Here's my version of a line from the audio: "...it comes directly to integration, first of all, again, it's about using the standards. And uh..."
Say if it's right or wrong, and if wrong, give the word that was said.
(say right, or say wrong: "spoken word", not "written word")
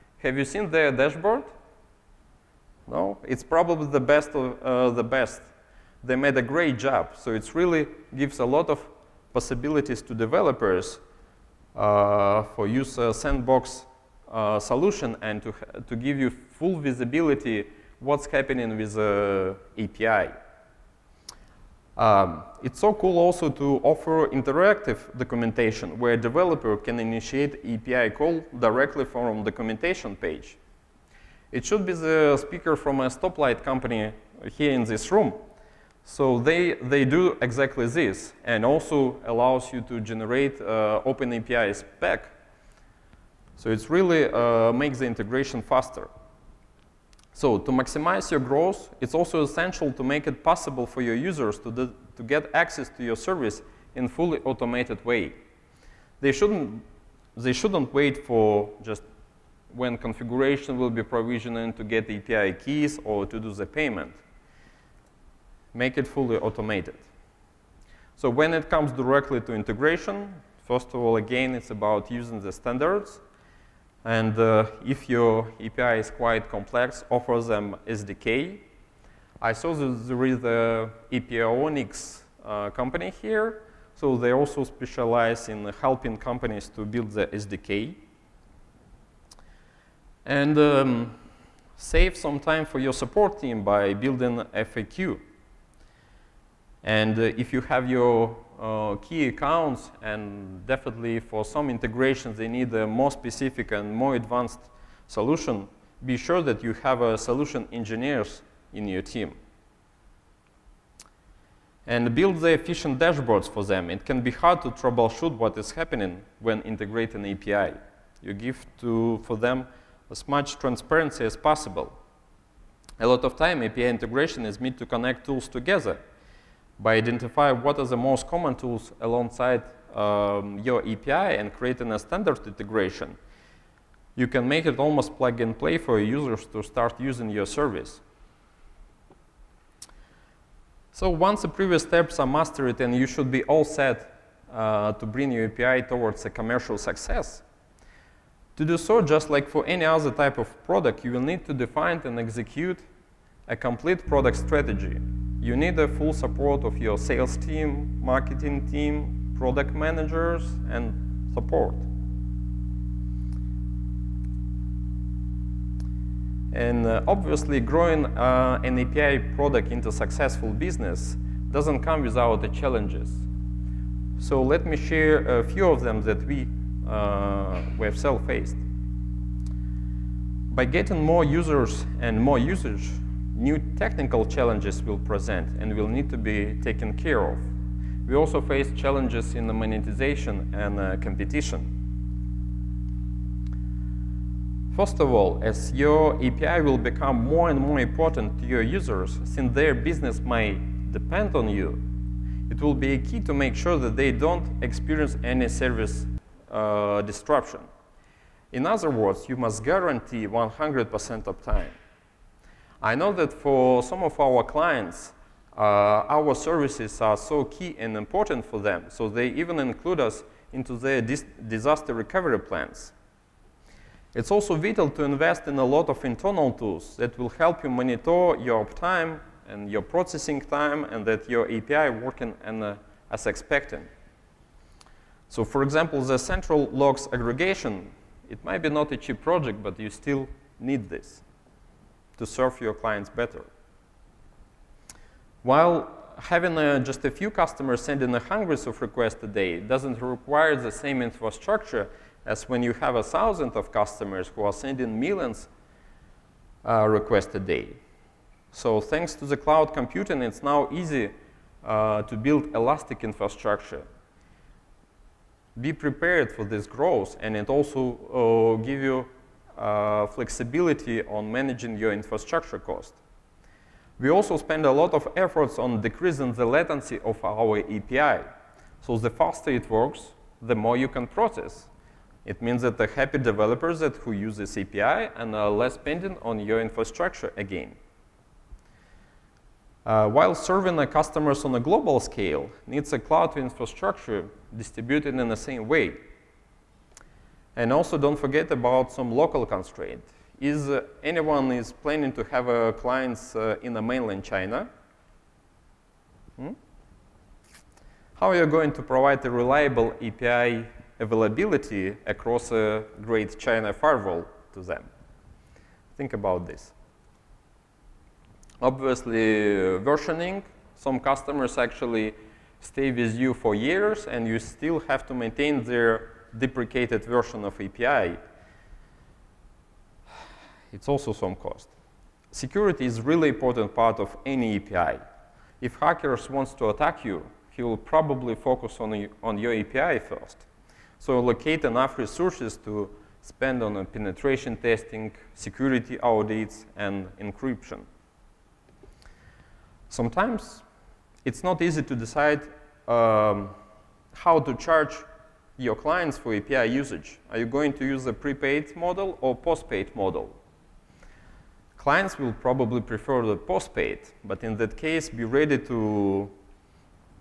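right.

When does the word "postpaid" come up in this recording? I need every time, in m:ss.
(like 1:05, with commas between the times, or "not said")
5:59, 6:03.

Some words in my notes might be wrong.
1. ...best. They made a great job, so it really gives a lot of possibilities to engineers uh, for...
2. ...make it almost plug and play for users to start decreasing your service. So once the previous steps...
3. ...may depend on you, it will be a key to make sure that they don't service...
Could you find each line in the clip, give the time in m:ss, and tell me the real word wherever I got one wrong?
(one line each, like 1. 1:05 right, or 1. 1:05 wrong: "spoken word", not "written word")
1. 0:05 wrong: "developers", not "engineers"
2. 2:14 wrong: "using", not "decreasing"
3. 3:20 wrong: "experience", not "service".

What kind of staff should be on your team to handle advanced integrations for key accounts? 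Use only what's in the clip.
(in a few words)
solution engineers.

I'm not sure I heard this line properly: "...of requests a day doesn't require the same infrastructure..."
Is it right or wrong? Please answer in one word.
right.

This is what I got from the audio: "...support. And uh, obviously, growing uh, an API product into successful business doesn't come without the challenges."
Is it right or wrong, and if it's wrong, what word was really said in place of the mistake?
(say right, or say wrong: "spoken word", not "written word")
right.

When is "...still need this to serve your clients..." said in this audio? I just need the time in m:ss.
3:59.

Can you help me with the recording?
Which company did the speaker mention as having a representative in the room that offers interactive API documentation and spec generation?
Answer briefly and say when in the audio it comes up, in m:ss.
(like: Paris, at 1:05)
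Stoplight, at 0:33.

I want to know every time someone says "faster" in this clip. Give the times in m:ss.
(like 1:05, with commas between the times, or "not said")
0:45, 4:39.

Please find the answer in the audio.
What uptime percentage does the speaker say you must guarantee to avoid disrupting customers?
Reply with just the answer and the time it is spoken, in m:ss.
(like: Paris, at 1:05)
100%, at 3:30.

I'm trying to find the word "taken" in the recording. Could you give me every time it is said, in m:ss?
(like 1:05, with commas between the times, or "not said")
3:06.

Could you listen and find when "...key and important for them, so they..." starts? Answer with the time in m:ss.
3:37.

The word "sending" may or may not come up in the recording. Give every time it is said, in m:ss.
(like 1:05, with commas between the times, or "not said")
4:07, 4:14.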